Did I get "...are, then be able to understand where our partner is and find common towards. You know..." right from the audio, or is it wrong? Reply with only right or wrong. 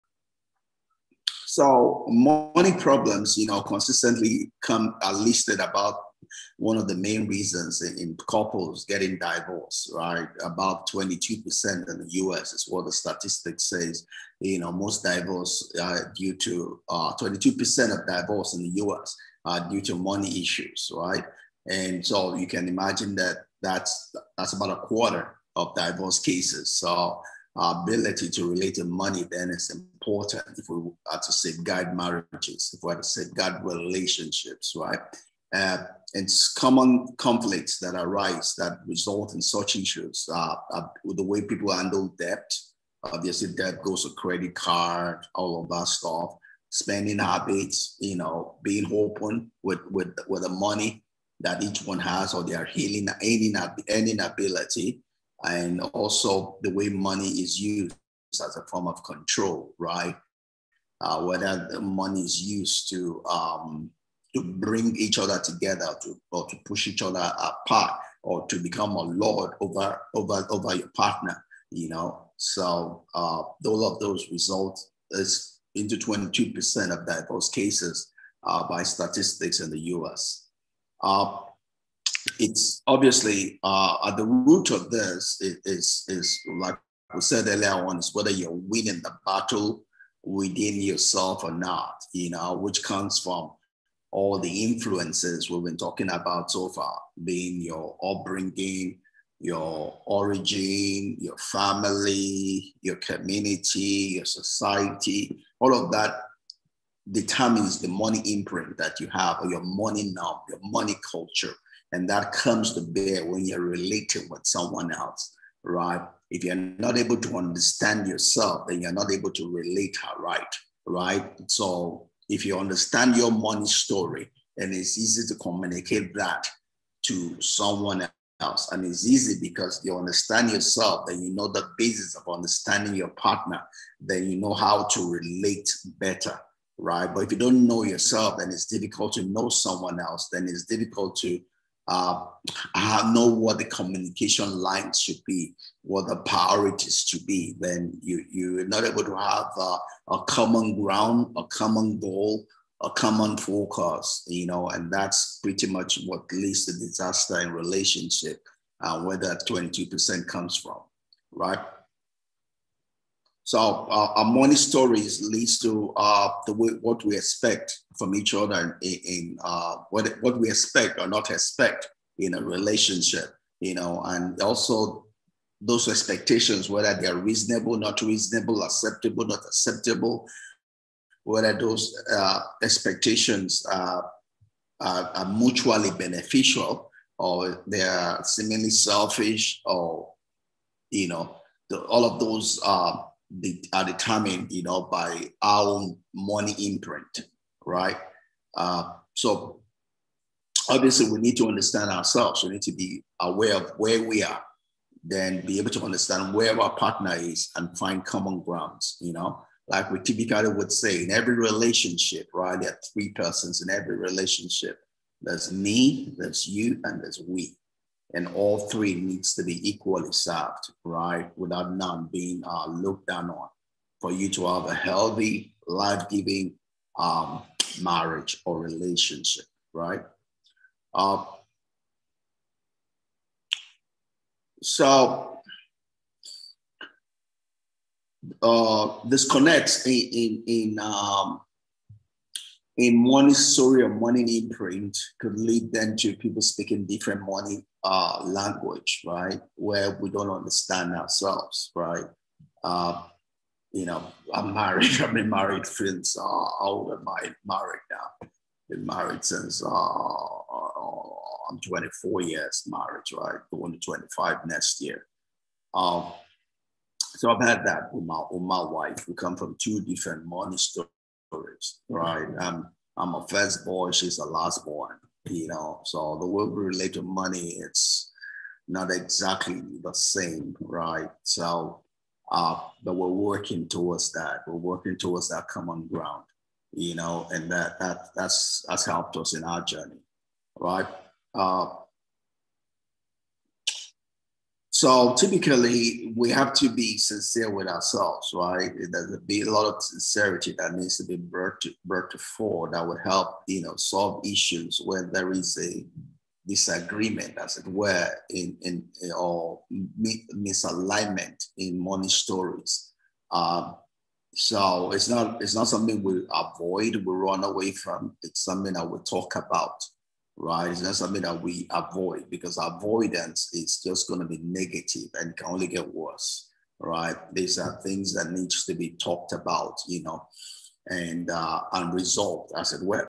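wrong.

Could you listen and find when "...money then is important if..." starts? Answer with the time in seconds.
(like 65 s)
28 s.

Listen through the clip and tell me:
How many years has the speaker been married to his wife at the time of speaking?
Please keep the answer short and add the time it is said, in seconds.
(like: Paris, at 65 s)
24, at 261 s.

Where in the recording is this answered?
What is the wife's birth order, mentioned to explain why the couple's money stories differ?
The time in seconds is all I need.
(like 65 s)
273 s.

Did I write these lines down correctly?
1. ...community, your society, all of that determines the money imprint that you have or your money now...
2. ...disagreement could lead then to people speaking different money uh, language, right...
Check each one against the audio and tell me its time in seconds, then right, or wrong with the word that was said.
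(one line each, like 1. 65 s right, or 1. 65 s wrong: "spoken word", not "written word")
1. 102 s right
2. 244 s wrong: "imprint", not "disagreement".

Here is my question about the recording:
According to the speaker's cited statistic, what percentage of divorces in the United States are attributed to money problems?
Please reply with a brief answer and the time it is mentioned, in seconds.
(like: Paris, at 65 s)
22%, at 10 s.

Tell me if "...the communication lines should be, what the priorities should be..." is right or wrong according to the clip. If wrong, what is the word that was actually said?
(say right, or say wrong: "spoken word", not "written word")
right.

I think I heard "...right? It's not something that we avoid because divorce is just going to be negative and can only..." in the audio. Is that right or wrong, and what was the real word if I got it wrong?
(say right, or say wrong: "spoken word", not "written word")
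wrong: "avoidance", not "divorce".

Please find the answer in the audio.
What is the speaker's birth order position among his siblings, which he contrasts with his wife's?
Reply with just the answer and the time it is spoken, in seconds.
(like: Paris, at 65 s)
first boy, at 272 s.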